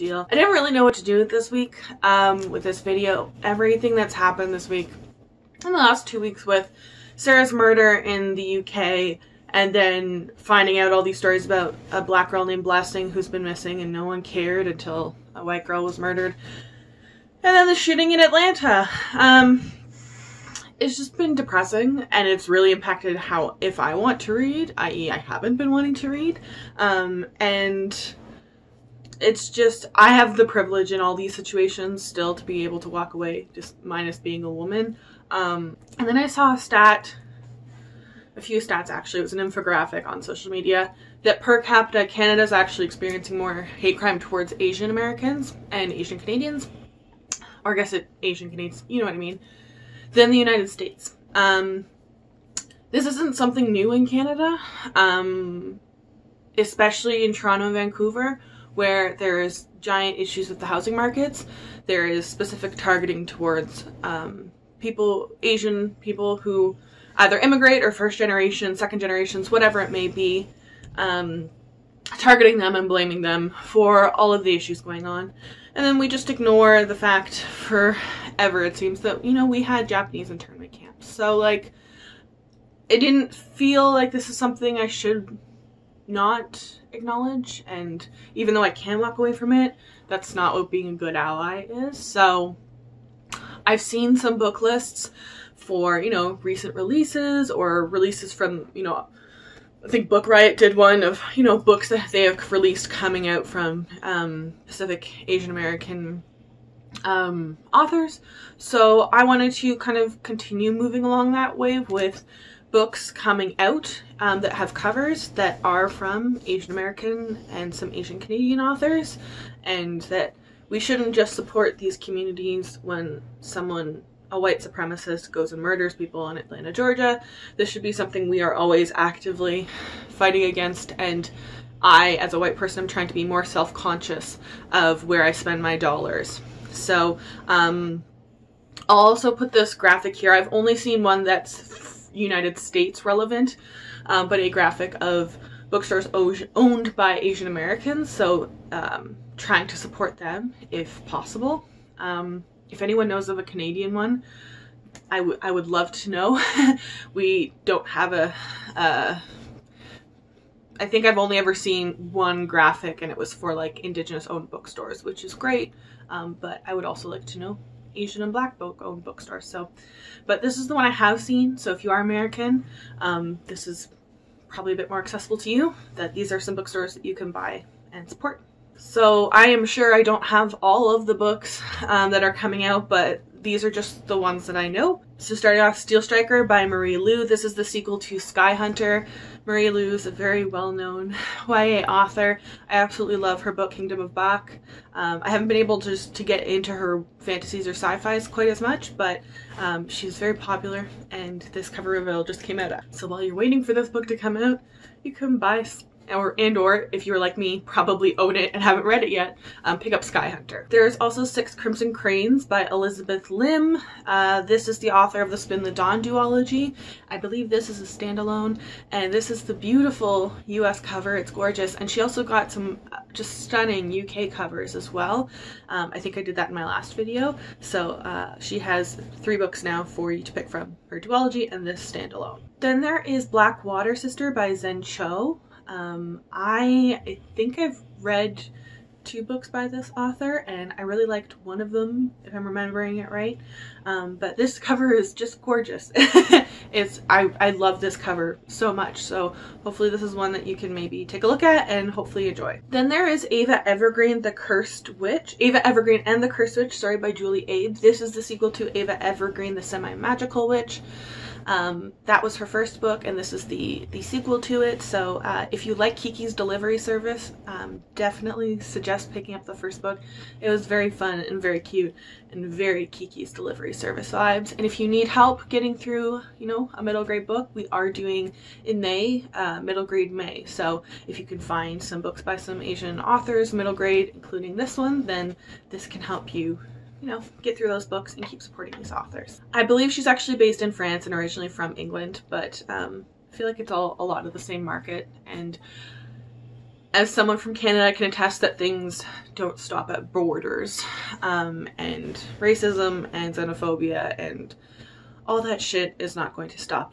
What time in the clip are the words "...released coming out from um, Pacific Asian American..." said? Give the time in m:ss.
1:42.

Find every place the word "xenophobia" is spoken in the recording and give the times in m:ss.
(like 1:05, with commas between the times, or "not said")
5:03.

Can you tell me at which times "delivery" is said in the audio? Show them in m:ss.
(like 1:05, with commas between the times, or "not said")
4:26, 4:33.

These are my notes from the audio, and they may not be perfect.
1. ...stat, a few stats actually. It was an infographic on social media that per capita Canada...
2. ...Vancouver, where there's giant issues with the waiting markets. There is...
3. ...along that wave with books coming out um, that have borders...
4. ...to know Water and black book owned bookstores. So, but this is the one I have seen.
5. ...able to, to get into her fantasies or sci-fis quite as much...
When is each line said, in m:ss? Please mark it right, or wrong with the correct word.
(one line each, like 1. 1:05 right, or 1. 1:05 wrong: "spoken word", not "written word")
1. 0:36 right
2. 0:57 wrong: "housing", not "waiting"
3. 1:51 wrong: "covers", not "borders"
4. 2:47 wrong: "Asian", not "Water"
5. 3:15 right.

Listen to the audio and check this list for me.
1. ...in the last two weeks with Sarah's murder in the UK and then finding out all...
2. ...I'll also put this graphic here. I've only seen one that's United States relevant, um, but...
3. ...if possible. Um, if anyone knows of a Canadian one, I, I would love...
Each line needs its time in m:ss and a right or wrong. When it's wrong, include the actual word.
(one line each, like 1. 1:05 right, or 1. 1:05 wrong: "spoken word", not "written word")
1. 0:05 right
2. 2:18 right
3. 2:30 right.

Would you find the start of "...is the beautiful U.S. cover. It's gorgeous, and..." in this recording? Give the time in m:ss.
3:39.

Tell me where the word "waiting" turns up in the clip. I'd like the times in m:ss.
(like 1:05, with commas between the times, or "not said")
3:23.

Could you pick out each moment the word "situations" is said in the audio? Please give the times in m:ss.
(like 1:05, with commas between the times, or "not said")
0:31.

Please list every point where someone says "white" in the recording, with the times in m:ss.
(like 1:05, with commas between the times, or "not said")
0:15, 2:04, 2:12.